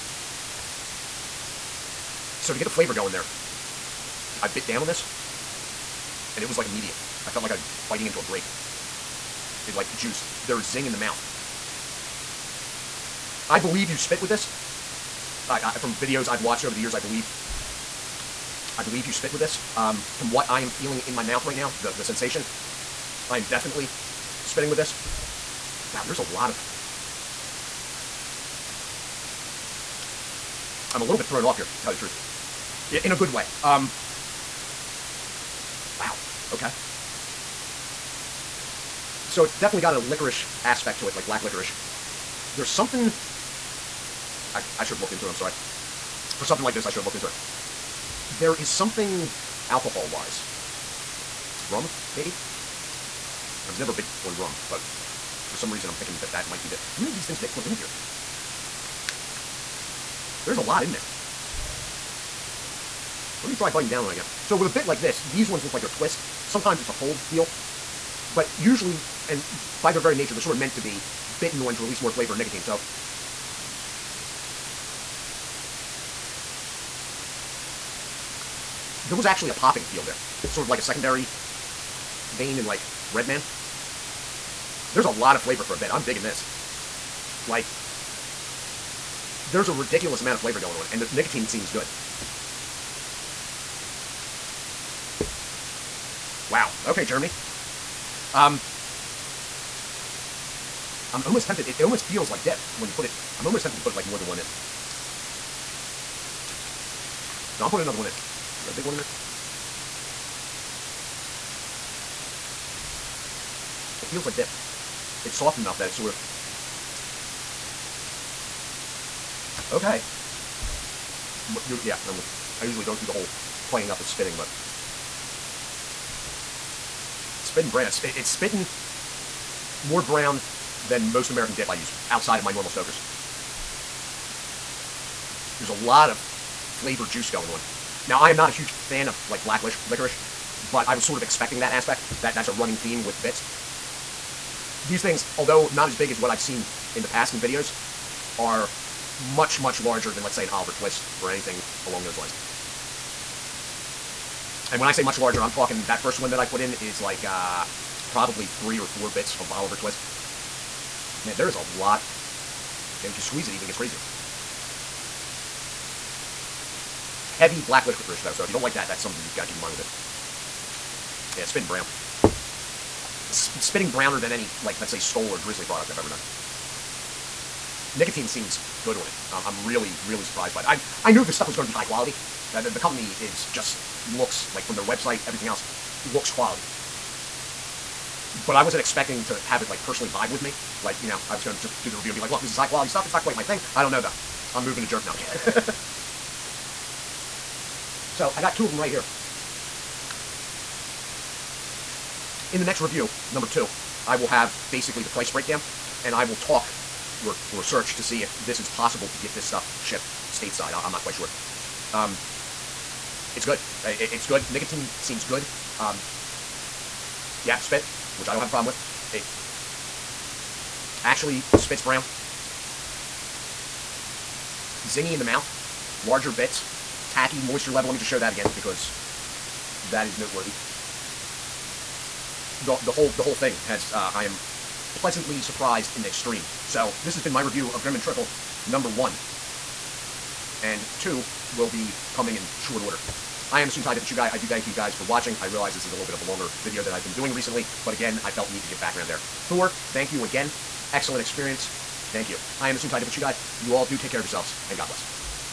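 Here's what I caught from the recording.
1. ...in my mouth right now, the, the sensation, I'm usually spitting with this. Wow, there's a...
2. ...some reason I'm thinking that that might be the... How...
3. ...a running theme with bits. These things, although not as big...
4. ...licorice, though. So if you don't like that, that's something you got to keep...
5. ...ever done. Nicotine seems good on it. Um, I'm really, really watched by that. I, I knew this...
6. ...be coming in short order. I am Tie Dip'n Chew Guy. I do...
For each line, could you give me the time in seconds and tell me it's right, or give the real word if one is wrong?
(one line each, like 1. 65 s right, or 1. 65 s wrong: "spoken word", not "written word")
1. 20 s wrong: "definitely", not "usually"
2. 55 s right
3. 142 s right
4. 167 s right
5. 175 s wrong: "surprised", not "watched"
6. 241 s right.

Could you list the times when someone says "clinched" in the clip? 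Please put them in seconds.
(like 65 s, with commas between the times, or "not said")
not said.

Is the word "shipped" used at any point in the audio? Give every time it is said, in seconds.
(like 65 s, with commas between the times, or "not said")
209 s.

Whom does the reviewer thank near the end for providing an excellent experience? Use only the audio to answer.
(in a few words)
Thor.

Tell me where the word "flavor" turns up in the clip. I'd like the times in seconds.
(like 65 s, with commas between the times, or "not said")
2 s, 72 s, 85 s, 90 s, 136 s.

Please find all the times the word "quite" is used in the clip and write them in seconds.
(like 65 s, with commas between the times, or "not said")
193 s, 211 s.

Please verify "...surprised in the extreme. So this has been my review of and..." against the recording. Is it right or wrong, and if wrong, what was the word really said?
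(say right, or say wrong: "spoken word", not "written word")
right.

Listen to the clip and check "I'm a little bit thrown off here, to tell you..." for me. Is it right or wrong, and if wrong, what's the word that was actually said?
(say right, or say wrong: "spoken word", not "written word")
right.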